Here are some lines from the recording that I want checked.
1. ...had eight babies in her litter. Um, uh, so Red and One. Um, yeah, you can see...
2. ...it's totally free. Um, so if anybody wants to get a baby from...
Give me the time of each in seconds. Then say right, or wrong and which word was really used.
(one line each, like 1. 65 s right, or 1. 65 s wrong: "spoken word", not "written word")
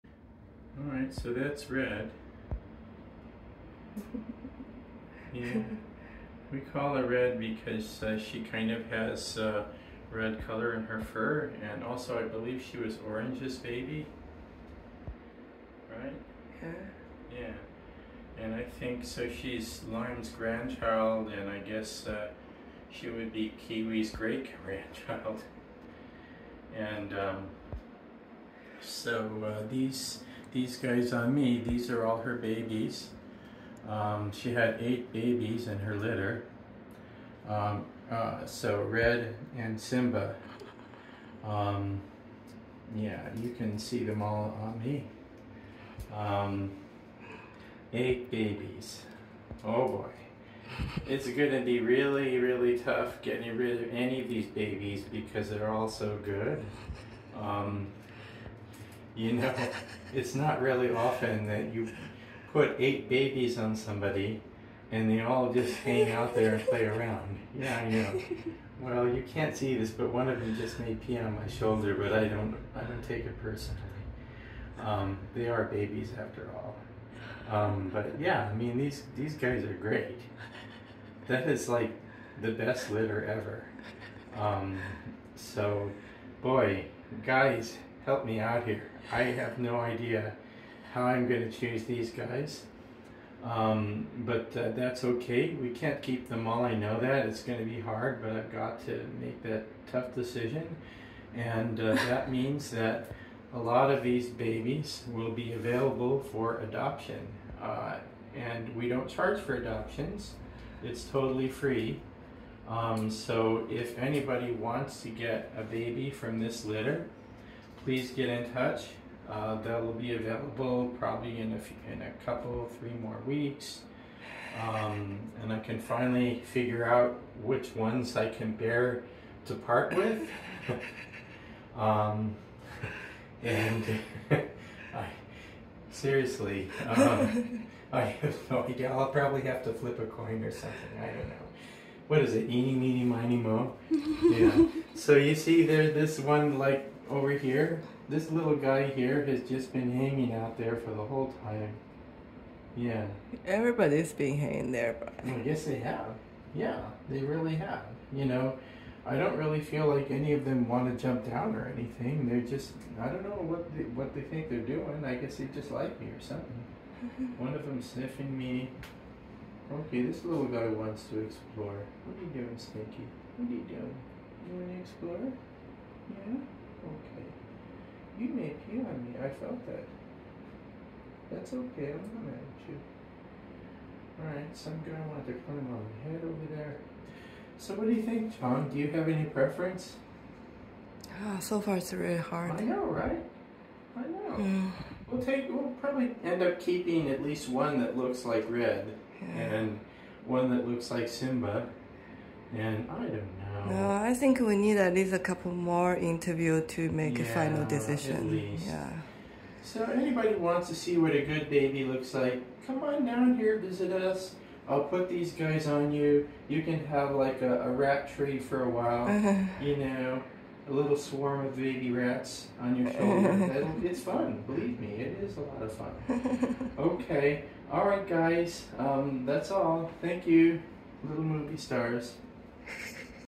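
1. 34 s wrong: "Simba", not "One"
2. 110 s right.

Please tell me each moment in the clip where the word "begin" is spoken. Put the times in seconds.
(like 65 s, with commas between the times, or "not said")
not said.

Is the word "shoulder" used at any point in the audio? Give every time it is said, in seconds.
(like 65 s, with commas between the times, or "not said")
71 s, 222 s.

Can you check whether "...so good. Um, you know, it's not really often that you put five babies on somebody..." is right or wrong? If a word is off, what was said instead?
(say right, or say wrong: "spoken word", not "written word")
wrong: "eight", not "five".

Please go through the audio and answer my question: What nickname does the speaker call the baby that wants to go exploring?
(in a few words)
Stinky.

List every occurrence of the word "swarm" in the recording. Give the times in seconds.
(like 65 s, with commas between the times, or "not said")
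220 s.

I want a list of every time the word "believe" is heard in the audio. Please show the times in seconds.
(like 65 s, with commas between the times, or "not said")
12 s, 224 s.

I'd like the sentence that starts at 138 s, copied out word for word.
I'll probably have to flip a coin or something.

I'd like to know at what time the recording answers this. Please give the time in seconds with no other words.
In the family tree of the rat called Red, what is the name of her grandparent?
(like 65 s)
19 s.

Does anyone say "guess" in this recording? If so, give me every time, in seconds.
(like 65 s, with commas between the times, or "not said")
21 s, 155 s, 165 s.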